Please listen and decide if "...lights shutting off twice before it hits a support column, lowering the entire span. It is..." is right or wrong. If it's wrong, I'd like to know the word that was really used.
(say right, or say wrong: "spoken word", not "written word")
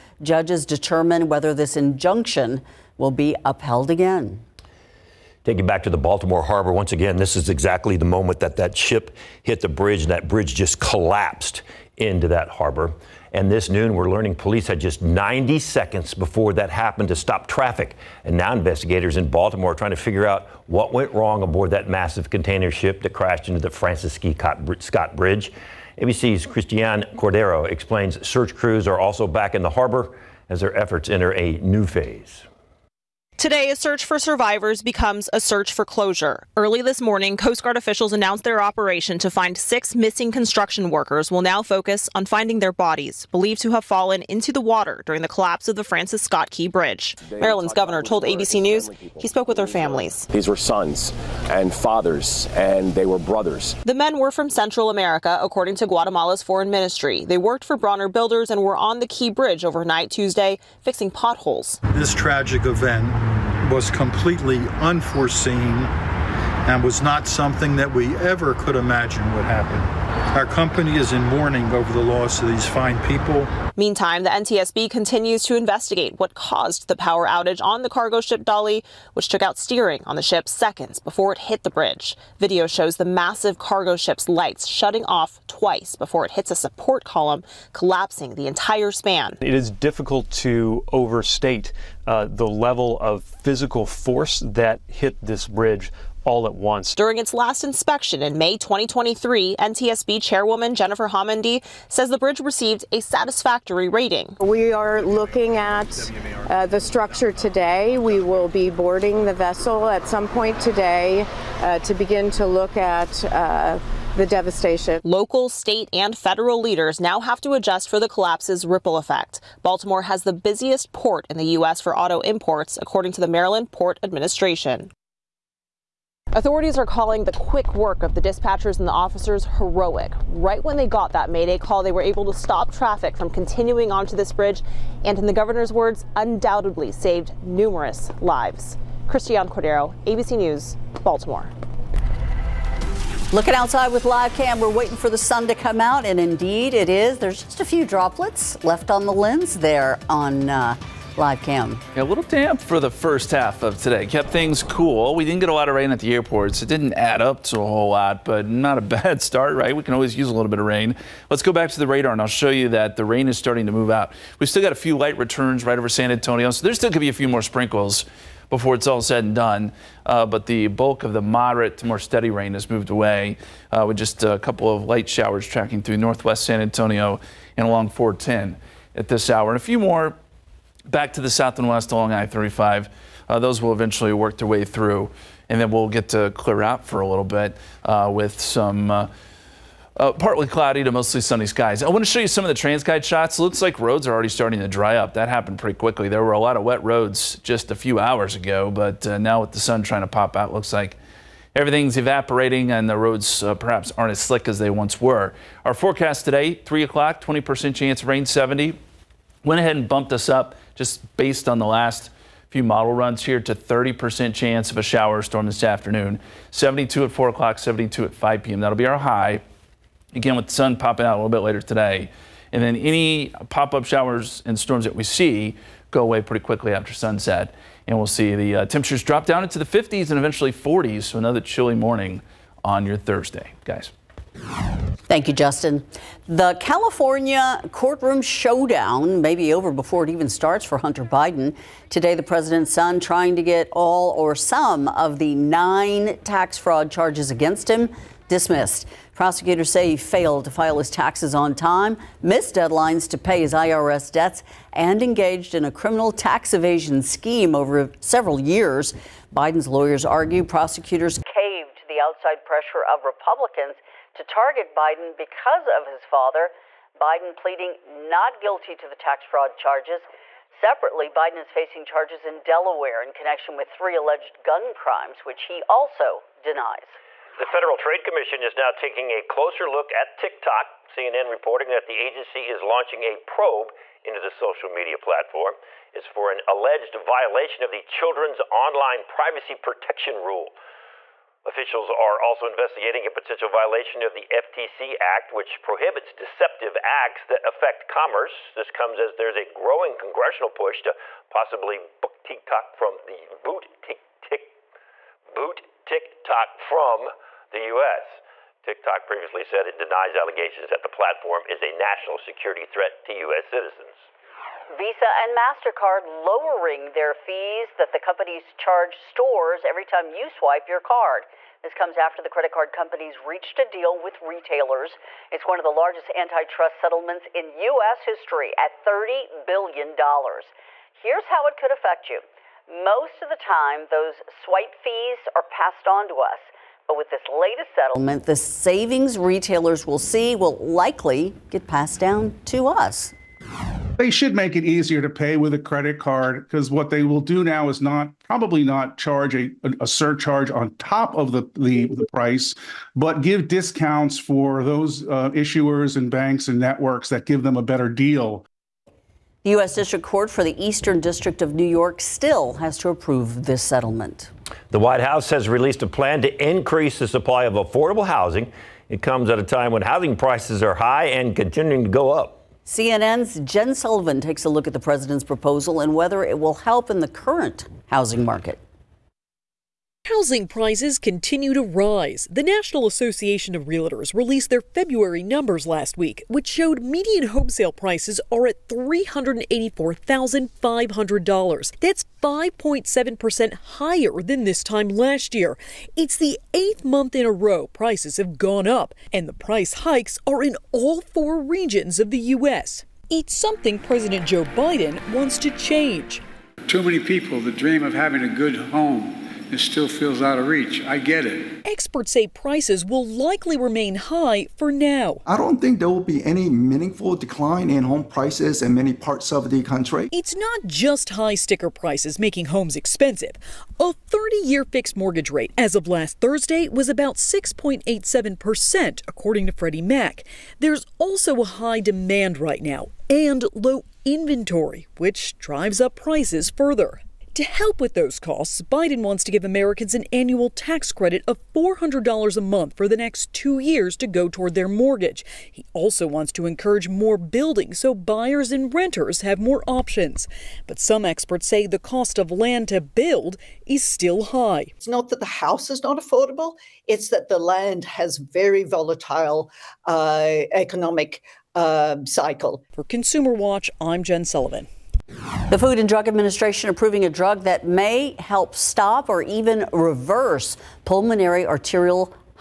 wrong: "collapsing", not "lowering".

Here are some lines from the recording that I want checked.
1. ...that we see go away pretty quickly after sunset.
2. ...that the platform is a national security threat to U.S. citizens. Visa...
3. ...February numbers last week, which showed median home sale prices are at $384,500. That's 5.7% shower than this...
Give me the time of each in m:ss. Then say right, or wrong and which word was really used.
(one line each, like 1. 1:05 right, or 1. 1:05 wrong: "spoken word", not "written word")
1. 3:44 right
2. 5:10 right
3. 6:24 wrong: "higher", not "shower".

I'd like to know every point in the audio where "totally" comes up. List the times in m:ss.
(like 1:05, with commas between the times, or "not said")
not said.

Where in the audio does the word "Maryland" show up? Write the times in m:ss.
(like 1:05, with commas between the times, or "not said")
0:47, 2:03.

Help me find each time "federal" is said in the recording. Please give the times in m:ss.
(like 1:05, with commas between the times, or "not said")
1:56, 4:37.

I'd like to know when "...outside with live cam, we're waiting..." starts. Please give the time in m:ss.
2:23.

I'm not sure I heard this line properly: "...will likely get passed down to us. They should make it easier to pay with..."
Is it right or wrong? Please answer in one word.
right.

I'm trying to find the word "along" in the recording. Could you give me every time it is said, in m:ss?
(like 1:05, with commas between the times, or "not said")
2:57, 3:01.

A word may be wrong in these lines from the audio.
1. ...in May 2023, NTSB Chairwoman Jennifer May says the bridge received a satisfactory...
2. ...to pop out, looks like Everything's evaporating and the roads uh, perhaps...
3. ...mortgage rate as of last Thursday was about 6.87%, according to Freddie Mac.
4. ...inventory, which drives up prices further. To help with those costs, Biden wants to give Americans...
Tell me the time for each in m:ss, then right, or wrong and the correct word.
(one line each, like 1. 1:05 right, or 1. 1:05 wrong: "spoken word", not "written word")
1. 1:38 wrong: "Homendy", not "May"
2. 3:20 right
3. 7:04 right
4. 7:14 right.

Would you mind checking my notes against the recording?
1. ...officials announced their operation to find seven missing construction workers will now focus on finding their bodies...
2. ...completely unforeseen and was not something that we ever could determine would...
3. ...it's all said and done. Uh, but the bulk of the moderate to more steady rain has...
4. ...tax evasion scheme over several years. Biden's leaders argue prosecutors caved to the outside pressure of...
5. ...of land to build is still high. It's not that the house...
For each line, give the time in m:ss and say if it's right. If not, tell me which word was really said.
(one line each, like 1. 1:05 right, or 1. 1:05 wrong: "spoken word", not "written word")
1. 0:37 wrong: "six", not "seven"
2. 1:03 wrong: "imagine", not "determine"
3. 2:48 right
4. 4:16 wrong: "lawyers", not "leaders"
5. 7:32 right.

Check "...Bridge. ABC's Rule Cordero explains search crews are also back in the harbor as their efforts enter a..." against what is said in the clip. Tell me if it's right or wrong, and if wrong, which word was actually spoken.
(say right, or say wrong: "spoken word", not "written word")
wrong: "Christiane", not "Rule".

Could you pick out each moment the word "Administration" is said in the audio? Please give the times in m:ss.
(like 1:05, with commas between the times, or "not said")
2:04, 7:46.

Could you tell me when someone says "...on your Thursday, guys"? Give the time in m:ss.
3:52.